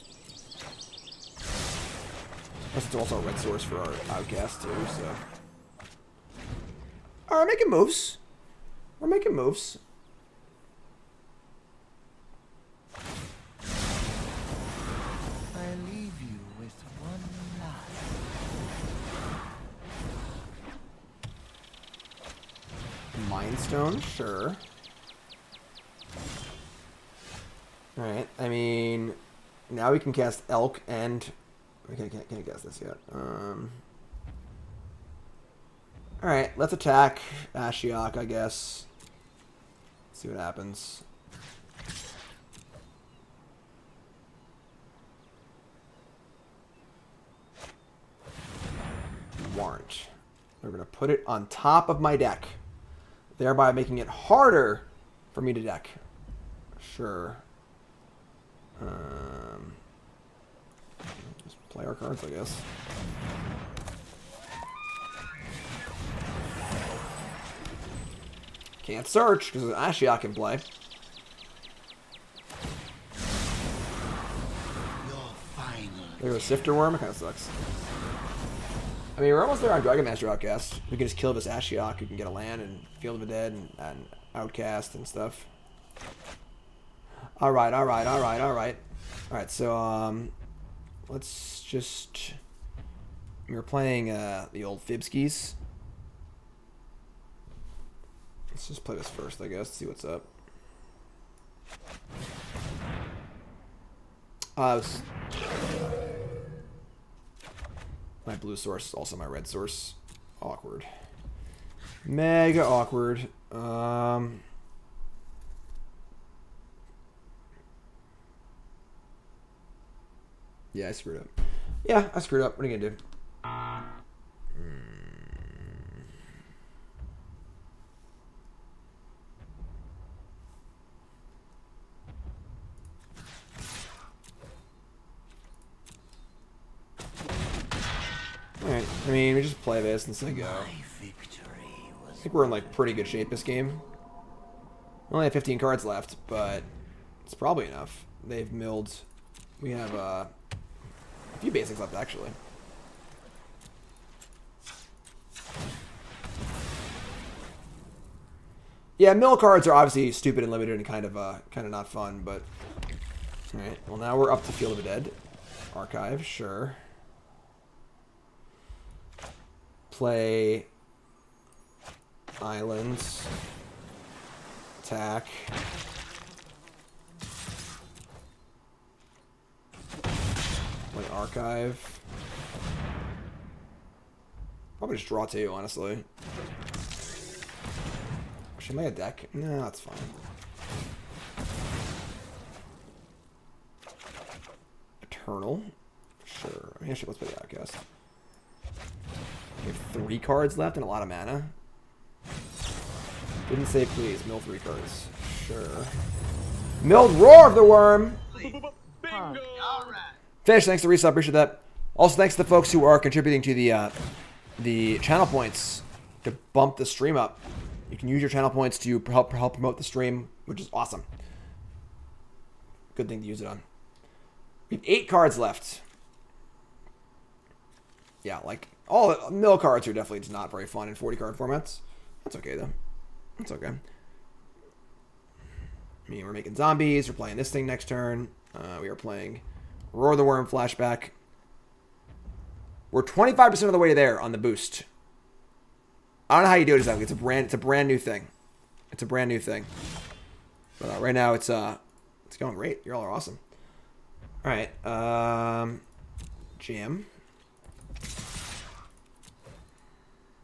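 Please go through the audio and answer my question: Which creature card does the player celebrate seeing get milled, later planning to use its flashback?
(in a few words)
Roar of the Wurm.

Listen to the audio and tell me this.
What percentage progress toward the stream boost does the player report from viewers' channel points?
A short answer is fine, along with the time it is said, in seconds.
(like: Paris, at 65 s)
25%, at 243 s.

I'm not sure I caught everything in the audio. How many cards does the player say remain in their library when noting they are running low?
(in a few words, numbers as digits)
15.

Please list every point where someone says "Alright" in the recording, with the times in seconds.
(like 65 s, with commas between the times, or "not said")
7 s, 138 s, 163 s, 209 s.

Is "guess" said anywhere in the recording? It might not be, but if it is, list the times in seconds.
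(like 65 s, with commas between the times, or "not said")
38 s, 62 s, 99 s, 197 s.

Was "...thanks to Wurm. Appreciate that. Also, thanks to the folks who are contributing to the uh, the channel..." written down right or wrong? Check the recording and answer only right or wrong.
wrong.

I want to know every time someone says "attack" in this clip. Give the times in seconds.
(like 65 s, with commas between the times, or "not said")
36 s, 174 s.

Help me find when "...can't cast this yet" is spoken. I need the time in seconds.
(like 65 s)
32 s.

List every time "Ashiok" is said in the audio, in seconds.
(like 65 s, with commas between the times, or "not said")
37 s, 69 s, 81 s.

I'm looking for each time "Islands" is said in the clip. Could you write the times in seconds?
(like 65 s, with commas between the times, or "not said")
172 s.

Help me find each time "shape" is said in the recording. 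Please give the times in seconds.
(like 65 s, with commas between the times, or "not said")
143 s.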